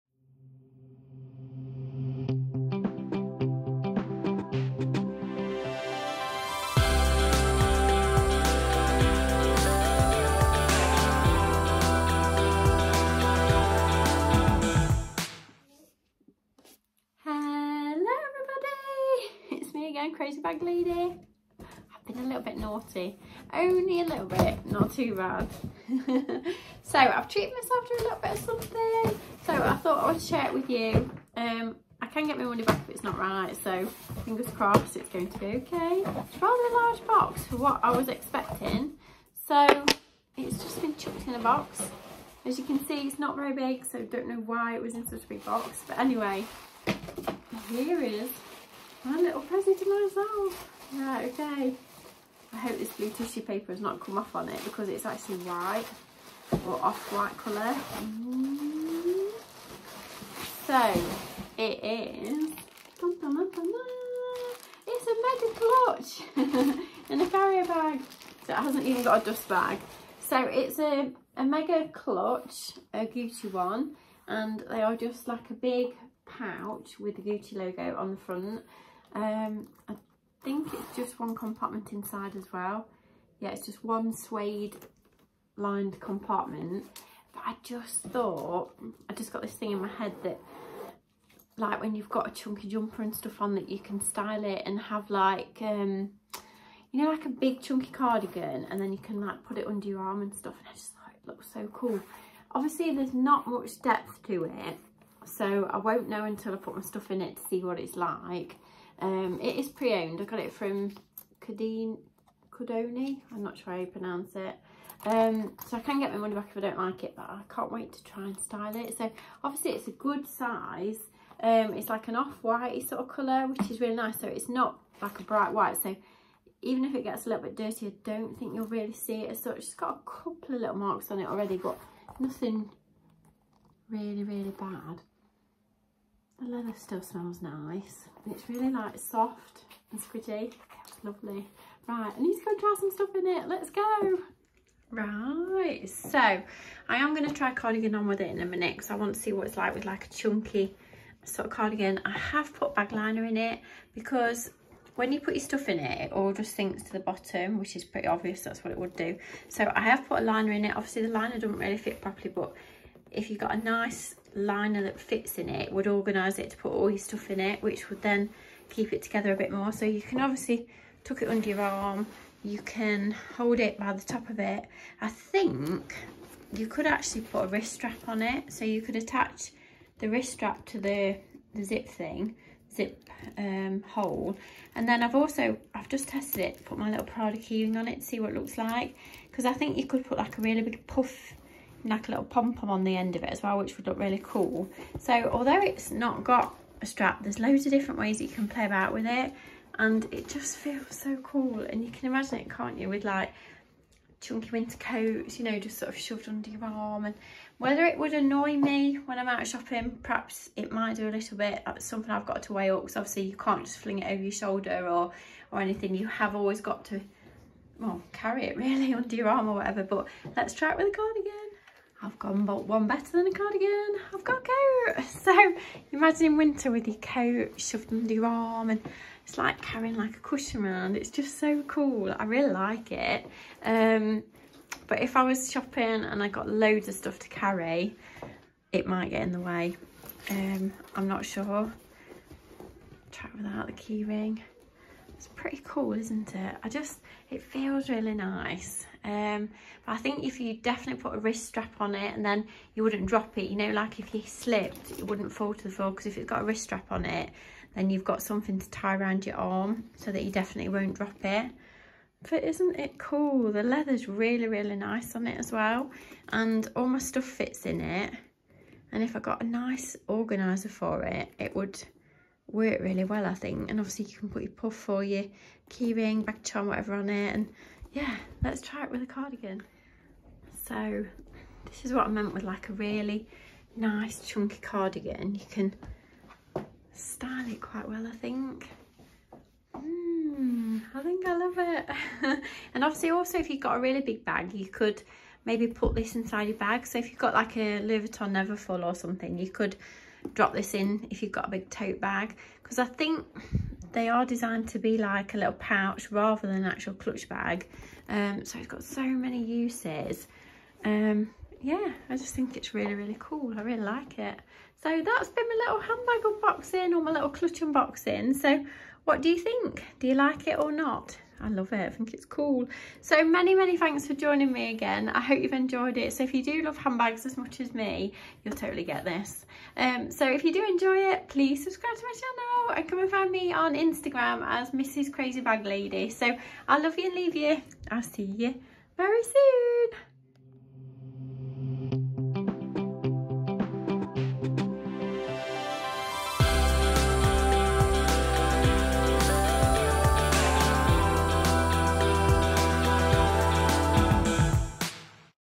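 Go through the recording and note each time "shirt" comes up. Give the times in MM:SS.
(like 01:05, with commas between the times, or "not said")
not said.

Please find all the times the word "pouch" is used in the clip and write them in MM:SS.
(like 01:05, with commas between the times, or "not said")
01:16, 05:05.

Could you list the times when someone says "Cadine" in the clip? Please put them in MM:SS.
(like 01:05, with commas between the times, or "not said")
01:51.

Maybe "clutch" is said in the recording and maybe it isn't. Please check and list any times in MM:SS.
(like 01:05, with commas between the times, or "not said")
01:06, 01:11, 05:06, 05:17.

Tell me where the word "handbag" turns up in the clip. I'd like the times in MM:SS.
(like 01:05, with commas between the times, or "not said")
05:15, 05:26.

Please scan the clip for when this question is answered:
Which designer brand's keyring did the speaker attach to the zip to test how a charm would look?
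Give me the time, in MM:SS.
03:07.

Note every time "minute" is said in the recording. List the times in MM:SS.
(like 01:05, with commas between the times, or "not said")
02:28.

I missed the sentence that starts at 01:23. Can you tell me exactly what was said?
Yeah, it's just one suede lined compartment.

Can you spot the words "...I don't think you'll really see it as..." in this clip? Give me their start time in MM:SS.
02:07.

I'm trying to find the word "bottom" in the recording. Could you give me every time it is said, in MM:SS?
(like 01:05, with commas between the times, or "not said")
02:37.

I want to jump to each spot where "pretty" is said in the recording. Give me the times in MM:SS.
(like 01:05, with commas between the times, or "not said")
02:37, 04:05.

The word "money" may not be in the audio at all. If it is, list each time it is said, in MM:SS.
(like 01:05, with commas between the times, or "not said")
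00:32, 01:56.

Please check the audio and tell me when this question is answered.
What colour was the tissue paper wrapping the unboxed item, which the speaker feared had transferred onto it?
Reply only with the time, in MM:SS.
00:52.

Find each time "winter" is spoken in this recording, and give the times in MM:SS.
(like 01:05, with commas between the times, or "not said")
03:24, 03:46.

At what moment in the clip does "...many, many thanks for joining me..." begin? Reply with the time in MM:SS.
05:23.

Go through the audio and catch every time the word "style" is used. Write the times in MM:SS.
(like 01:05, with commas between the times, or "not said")
01:34, 01:58, 04:46.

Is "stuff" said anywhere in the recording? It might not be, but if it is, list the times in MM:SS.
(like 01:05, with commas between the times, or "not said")
01:33, 01:40, 01:46, 02:22, 02:35, 02:46, 03:56, 04:26.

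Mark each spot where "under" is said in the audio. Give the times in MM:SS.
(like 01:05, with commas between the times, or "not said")
01:39, 02:51, 03:26, 03:38, 03:47.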